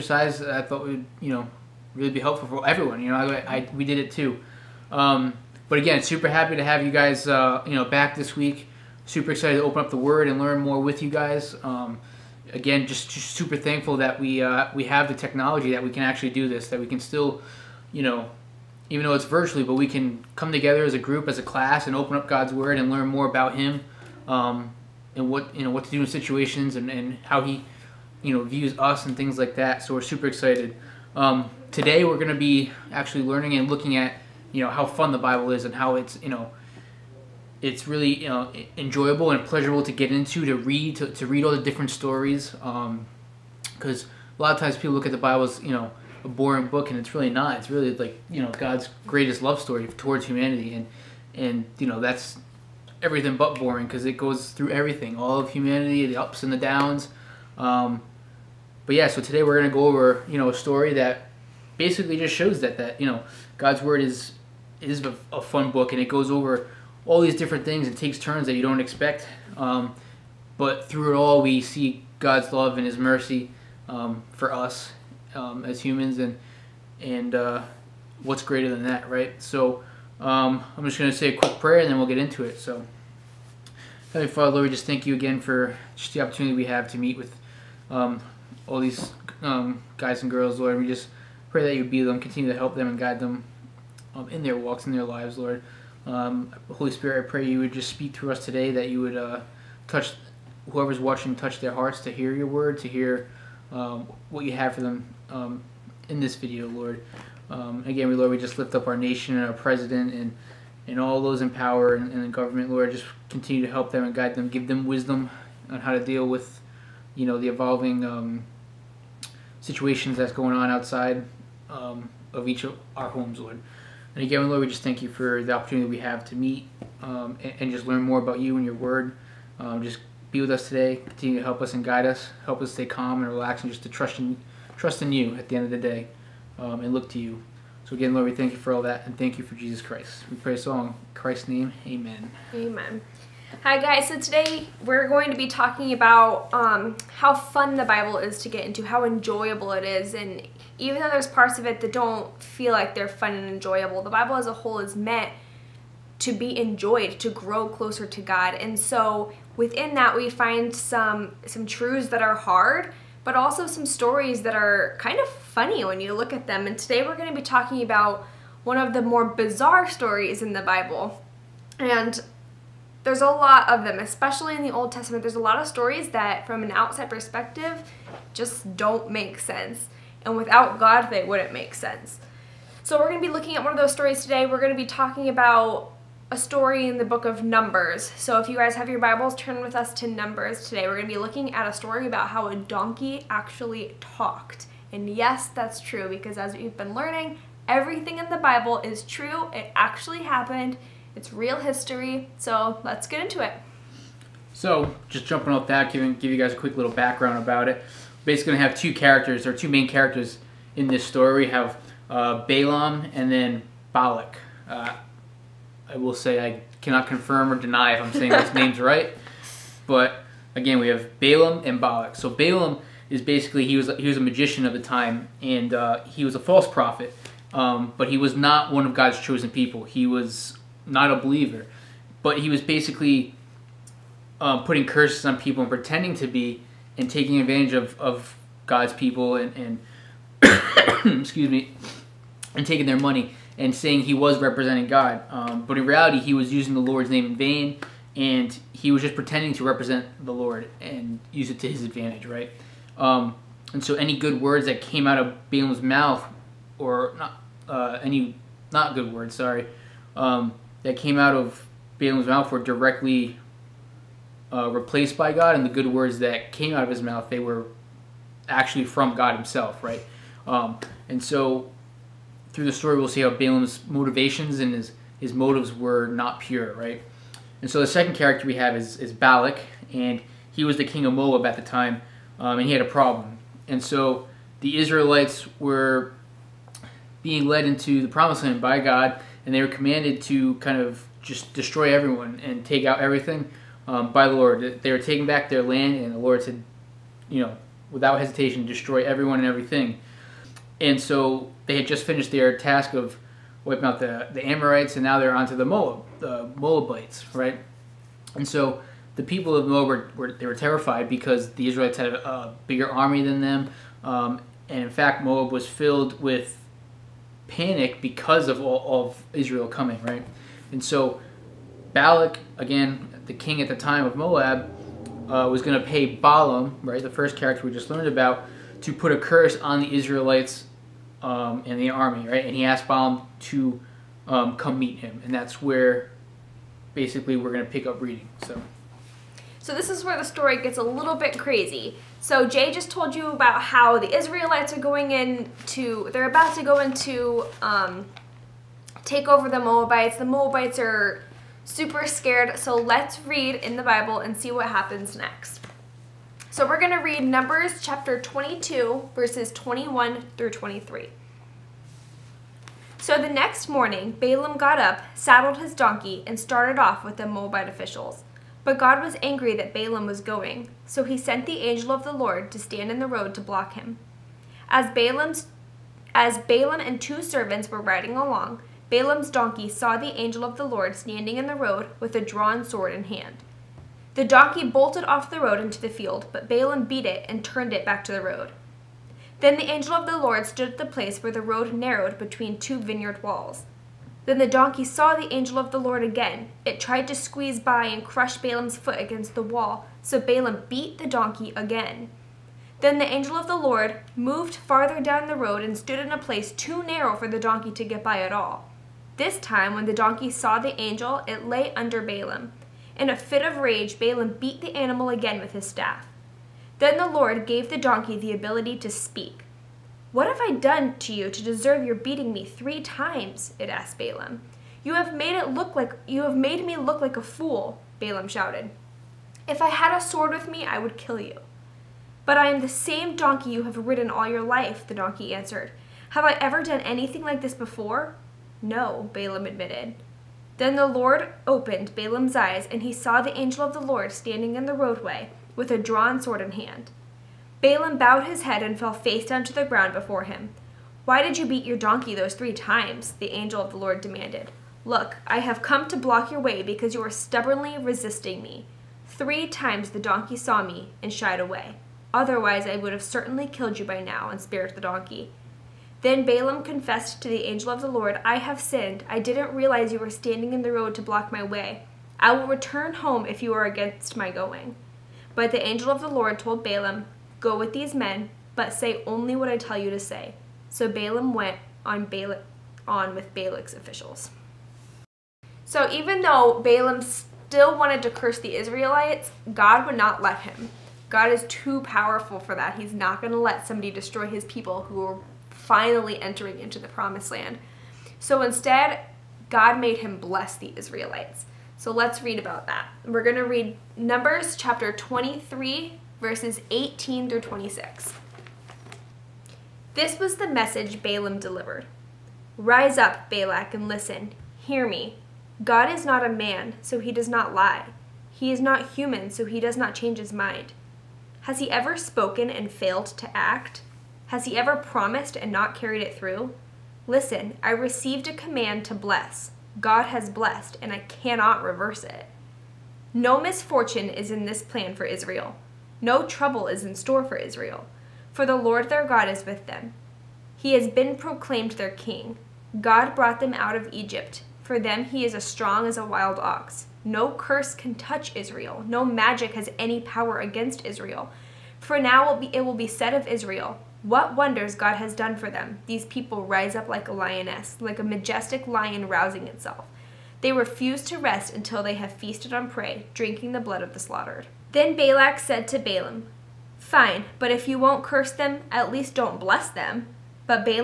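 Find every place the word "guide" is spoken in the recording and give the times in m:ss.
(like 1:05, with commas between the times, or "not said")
1:32, 1:54, 2:11.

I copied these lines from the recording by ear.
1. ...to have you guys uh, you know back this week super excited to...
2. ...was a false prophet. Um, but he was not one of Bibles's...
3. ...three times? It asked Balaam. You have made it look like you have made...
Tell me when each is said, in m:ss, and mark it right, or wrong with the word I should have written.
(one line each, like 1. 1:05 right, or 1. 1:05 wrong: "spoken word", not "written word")
1. 0:06 right
2. 3:46 wrong: "God", not "Bibles"
3. 7:02 right.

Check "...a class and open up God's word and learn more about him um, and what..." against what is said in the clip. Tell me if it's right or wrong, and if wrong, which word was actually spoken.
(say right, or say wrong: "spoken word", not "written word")
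right.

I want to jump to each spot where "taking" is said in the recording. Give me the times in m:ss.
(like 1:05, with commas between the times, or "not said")
3:57, 4:02, 4:54.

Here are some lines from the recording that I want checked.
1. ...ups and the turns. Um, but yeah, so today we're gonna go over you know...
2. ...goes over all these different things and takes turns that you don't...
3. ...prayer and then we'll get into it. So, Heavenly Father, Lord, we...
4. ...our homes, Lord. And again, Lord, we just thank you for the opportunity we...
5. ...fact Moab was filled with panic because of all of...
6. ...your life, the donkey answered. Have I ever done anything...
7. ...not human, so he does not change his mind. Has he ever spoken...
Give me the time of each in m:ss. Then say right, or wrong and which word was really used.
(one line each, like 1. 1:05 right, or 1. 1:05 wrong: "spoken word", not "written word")
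1. 0:56 wrong: "downs", not "turns"
2. 1:06 right
3. 1:21 right
4. 2:02 right
5. 5:14 right
6. 7:14 right
7. 8:38 right.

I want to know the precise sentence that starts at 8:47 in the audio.
Listen, I received a command to bless.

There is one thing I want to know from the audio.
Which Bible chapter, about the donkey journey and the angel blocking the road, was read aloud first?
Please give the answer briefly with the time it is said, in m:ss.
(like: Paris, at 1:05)
Chapter 22, at 5:57.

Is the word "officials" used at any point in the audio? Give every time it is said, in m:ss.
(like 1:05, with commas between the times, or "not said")
6:07, 8:03.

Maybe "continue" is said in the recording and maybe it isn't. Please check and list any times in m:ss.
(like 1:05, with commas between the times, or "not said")
1:32, 1:53, 2:11.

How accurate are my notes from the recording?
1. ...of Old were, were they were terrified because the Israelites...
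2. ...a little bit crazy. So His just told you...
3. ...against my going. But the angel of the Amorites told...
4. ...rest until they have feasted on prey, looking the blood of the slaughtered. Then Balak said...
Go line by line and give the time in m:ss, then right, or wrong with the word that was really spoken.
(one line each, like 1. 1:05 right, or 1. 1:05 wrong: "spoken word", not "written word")
1. 5:09 wrong: "Moab", not "Old"
2. 5:40 wrong: "Jay", not "His"
3. 7:53 wrong: "Lord", not "Amorites"
4. 9:21 wrong: "drinking", not "looking".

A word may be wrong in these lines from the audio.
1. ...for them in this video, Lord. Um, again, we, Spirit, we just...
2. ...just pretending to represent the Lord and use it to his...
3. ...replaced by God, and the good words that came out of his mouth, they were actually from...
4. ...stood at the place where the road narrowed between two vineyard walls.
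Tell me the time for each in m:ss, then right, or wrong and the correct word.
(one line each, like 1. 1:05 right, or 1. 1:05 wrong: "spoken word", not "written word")
1. 1:44 wrong: "Lord", not "Spirit"
2. 4:09 right
3. 4:24 right
4. 6:30 right.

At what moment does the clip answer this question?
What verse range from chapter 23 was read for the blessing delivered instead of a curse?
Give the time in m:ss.
8:26.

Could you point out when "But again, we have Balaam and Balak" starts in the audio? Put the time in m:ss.
3:39.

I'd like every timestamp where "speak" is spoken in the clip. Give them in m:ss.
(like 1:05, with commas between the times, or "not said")
1:37, 6:58.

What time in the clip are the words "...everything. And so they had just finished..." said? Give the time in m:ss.
4:59.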